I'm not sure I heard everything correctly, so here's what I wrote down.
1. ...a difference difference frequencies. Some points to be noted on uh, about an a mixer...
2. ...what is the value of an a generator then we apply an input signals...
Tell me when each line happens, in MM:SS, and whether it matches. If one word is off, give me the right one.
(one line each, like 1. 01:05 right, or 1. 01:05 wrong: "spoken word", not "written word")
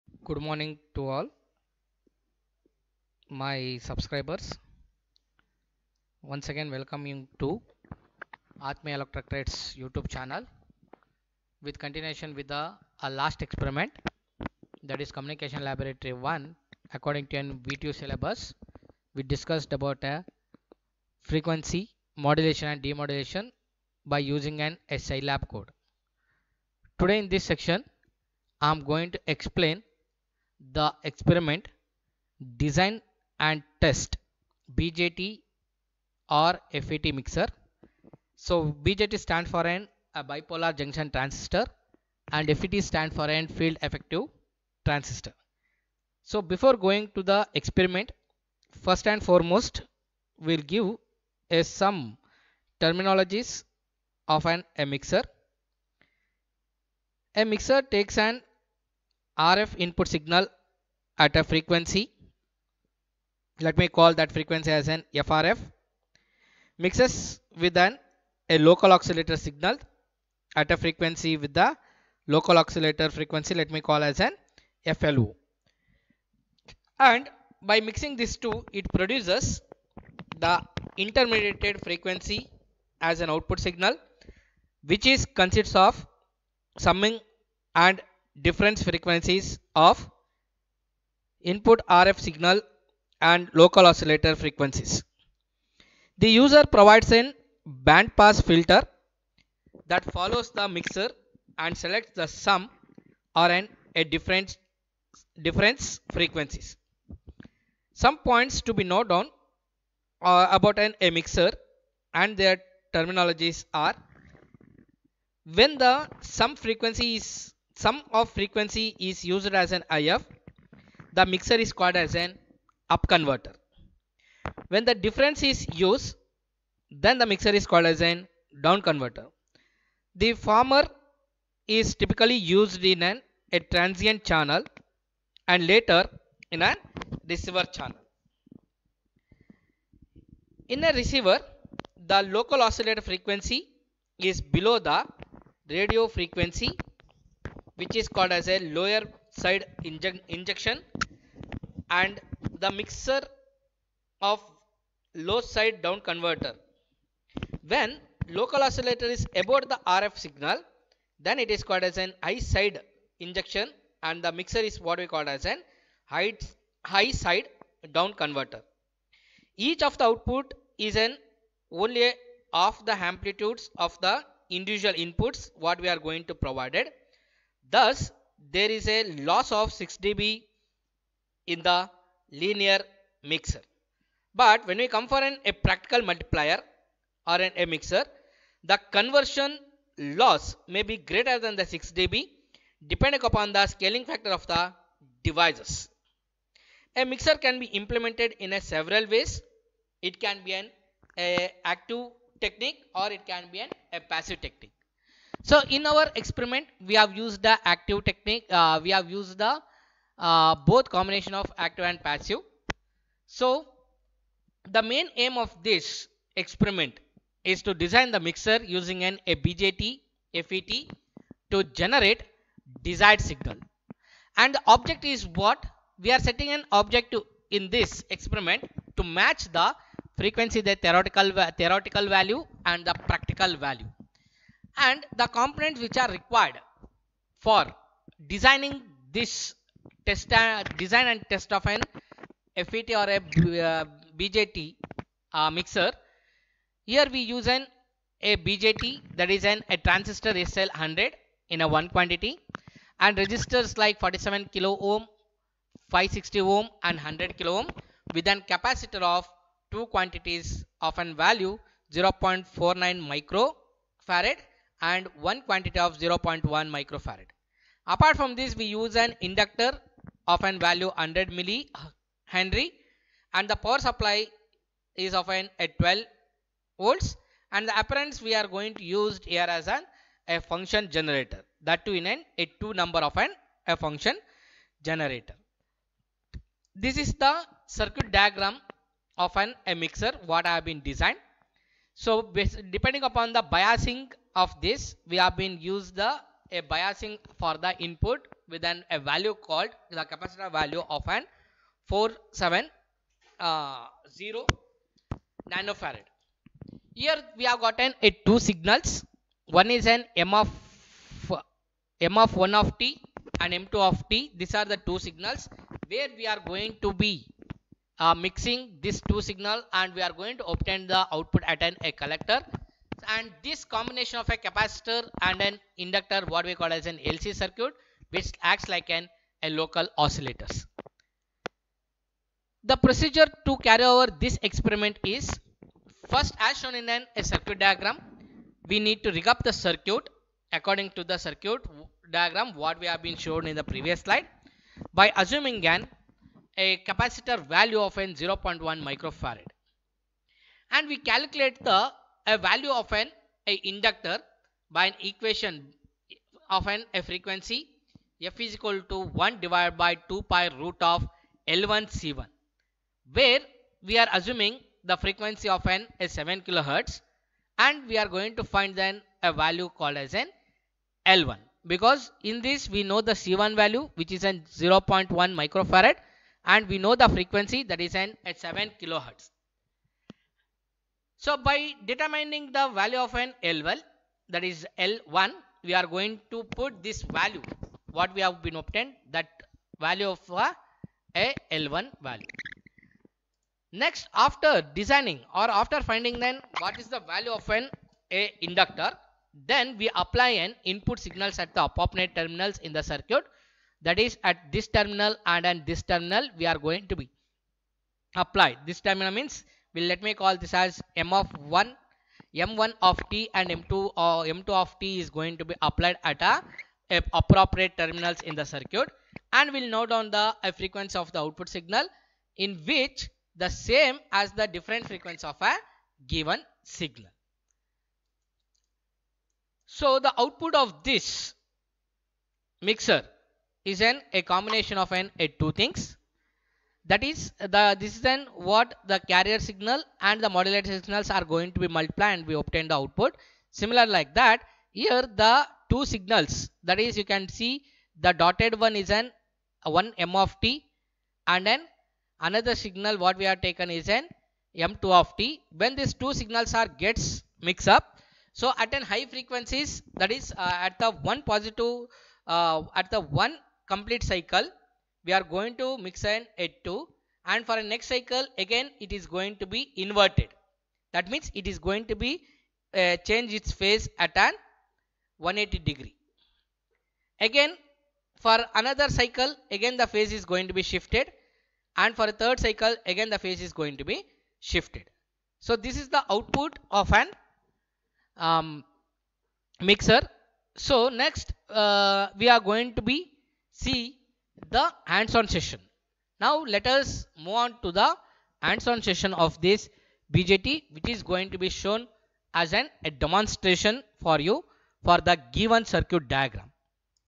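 1. 01:43 right
2. 06:36 wrong: "inductor", not "generator".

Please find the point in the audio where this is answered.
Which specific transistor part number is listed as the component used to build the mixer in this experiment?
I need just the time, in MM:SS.
04:10.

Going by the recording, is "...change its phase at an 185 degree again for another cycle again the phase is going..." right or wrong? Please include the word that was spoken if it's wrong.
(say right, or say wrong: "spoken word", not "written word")
wrong: "180", not "185".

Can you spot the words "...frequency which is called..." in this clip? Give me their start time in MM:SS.
02:26.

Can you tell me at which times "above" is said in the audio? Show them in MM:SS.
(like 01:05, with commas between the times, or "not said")
02:39.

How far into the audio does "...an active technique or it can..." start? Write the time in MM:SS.
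03:20.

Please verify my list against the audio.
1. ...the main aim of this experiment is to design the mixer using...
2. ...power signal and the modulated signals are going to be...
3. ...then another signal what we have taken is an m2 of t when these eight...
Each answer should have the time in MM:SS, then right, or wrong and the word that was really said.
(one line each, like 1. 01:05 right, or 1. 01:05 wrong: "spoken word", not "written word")
1. 03:34 right
2. 07:19 wrong: "carrier", not "power"
3. 07:31 wrong: "two", not "eight".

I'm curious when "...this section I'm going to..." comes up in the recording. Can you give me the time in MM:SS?
00:27.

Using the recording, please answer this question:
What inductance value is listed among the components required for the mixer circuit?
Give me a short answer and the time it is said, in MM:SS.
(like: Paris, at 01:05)
100 millihenry, at 04:30.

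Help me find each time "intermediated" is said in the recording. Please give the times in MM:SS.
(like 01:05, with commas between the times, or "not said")
01:21.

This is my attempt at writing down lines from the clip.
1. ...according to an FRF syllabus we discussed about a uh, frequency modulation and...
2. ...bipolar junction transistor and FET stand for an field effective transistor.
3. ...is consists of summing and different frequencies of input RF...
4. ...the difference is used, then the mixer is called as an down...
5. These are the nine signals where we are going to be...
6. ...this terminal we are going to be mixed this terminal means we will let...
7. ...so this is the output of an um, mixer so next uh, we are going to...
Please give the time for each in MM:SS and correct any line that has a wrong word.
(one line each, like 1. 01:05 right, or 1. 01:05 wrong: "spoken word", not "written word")
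1. 00:16 wrong: "VTU", not "FRF"
2. 00:40 right
3. 01:25 right
4. 02:04 right
5. 05:14 wrong: "two", not "nine"
6. 06:45 wrong: "applied", not "mixed"
7. 08:05 right.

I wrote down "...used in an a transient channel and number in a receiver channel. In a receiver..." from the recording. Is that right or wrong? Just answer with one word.
wrong.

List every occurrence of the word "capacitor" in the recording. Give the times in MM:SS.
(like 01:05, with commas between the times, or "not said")
04:18, 05:00, 05:24, 05:46.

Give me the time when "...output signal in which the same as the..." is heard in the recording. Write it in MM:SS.
07:01.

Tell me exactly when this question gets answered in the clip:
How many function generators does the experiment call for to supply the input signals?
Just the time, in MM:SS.
04:42.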